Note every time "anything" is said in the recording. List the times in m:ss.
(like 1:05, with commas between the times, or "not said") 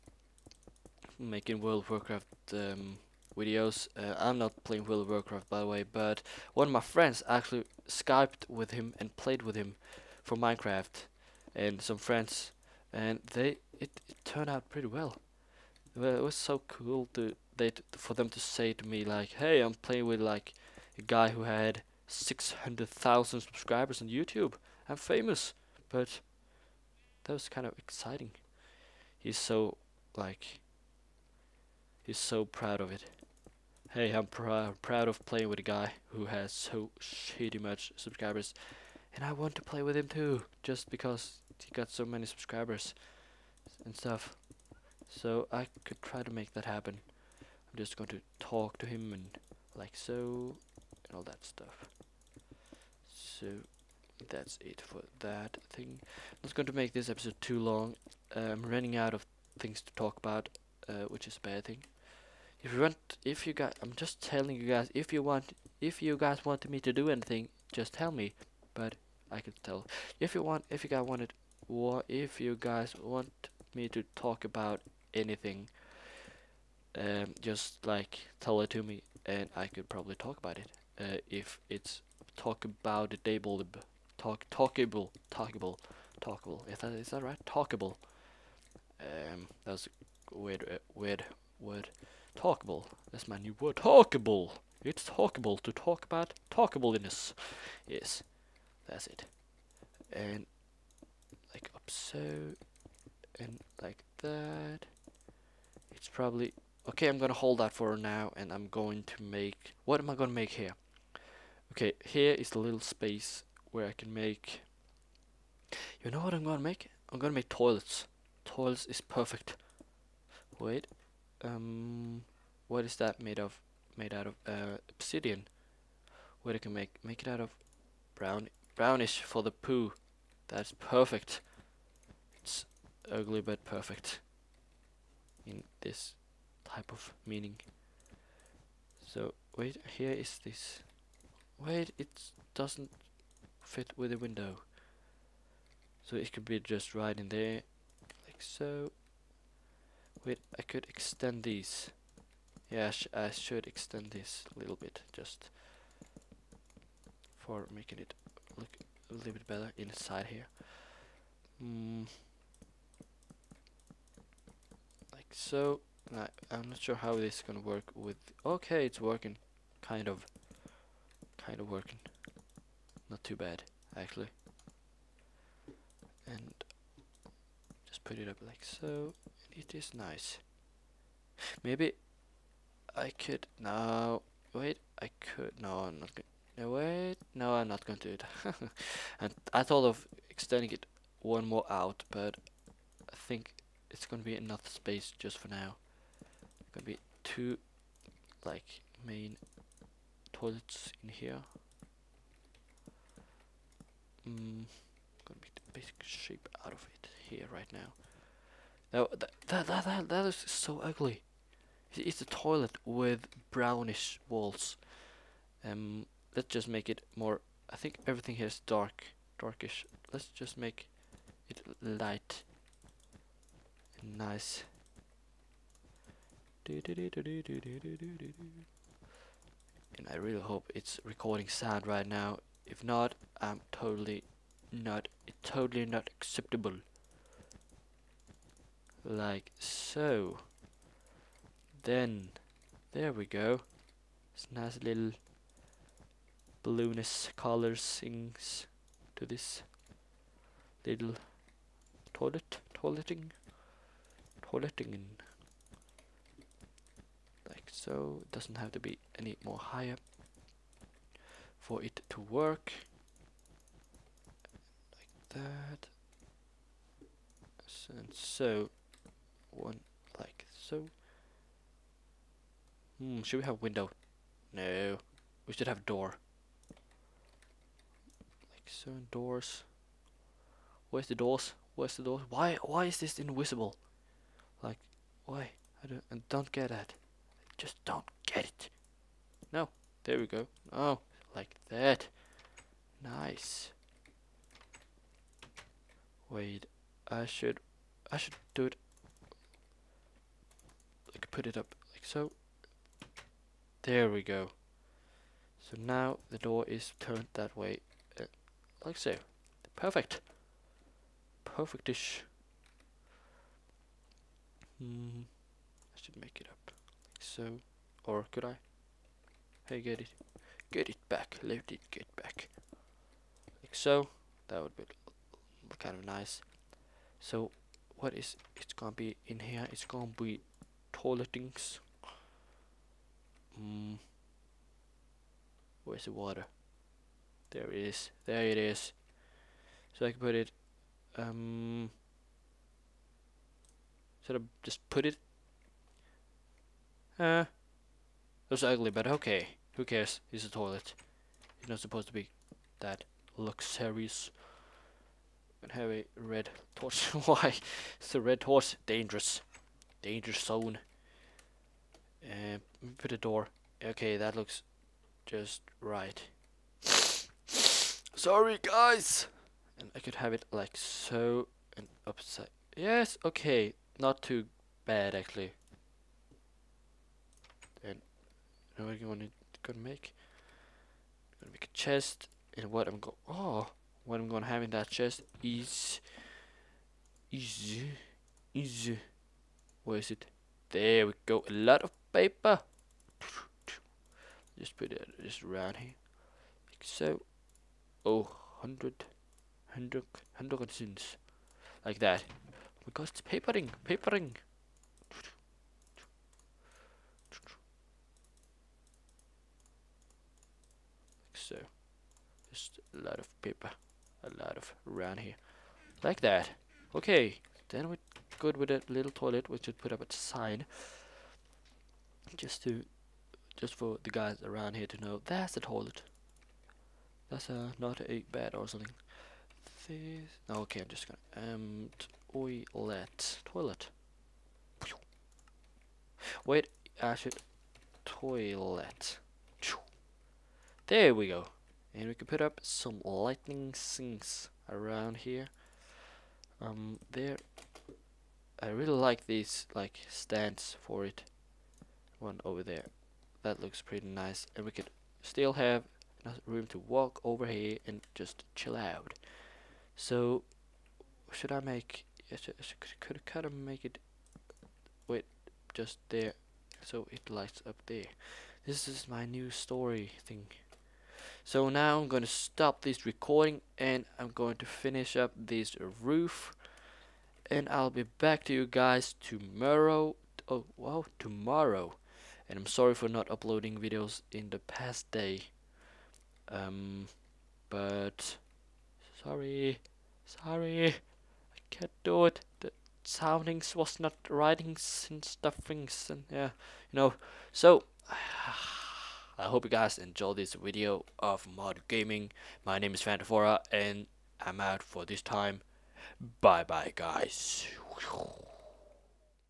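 1:07, 1:15.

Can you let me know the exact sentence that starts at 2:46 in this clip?
I, I'm not sure how this is gonna work with...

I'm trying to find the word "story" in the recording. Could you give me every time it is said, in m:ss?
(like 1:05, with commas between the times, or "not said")
7:49.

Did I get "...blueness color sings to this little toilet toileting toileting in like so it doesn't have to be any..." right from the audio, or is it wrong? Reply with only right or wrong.
right.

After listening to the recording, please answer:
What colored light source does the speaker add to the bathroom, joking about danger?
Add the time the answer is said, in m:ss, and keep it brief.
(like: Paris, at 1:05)
Red torch, at 5:56.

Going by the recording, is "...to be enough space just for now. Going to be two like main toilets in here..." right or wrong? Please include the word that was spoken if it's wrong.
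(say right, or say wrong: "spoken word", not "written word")
right.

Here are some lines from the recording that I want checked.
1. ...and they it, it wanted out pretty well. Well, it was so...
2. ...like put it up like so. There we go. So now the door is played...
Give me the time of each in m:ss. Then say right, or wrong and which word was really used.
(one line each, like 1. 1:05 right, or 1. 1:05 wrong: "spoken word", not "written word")
1. 0:12 wrong: "turned", not "wanted"
2. 5:01 wrong: "turned", not "played".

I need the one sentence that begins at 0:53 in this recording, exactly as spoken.
So that's it for that thing.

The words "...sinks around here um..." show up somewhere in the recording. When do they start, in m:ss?
7:23.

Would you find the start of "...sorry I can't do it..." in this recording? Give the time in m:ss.
8:10.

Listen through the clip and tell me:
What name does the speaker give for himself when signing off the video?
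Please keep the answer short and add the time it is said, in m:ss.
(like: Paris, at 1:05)
FantraFora, at 8:23.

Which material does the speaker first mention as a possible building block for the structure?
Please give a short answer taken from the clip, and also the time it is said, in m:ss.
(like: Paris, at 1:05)
Obsidian, at 2:04.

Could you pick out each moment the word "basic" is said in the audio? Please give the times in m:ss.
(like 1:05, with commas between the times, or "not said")
3:25.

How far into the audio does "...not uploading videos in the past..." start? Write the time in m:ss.
8:03.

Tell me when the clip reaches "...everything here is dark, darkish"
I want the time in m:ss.
3:38.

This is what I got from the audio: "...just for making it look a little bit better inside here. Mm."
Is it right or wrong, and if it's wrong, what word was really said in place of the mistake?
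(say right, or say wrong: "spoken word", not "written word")
right.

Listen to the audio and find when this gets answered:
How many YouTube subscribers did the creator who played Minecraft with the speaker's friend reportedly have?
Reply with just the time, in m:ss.
0:22.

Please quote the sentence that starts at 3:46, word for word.
And I really hope it's recording sound right now.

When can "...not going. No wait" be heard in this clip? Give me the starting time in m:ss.
3:05.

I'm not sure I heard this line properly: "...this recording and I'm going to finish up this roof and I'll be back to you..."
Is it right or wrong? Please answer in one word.
right.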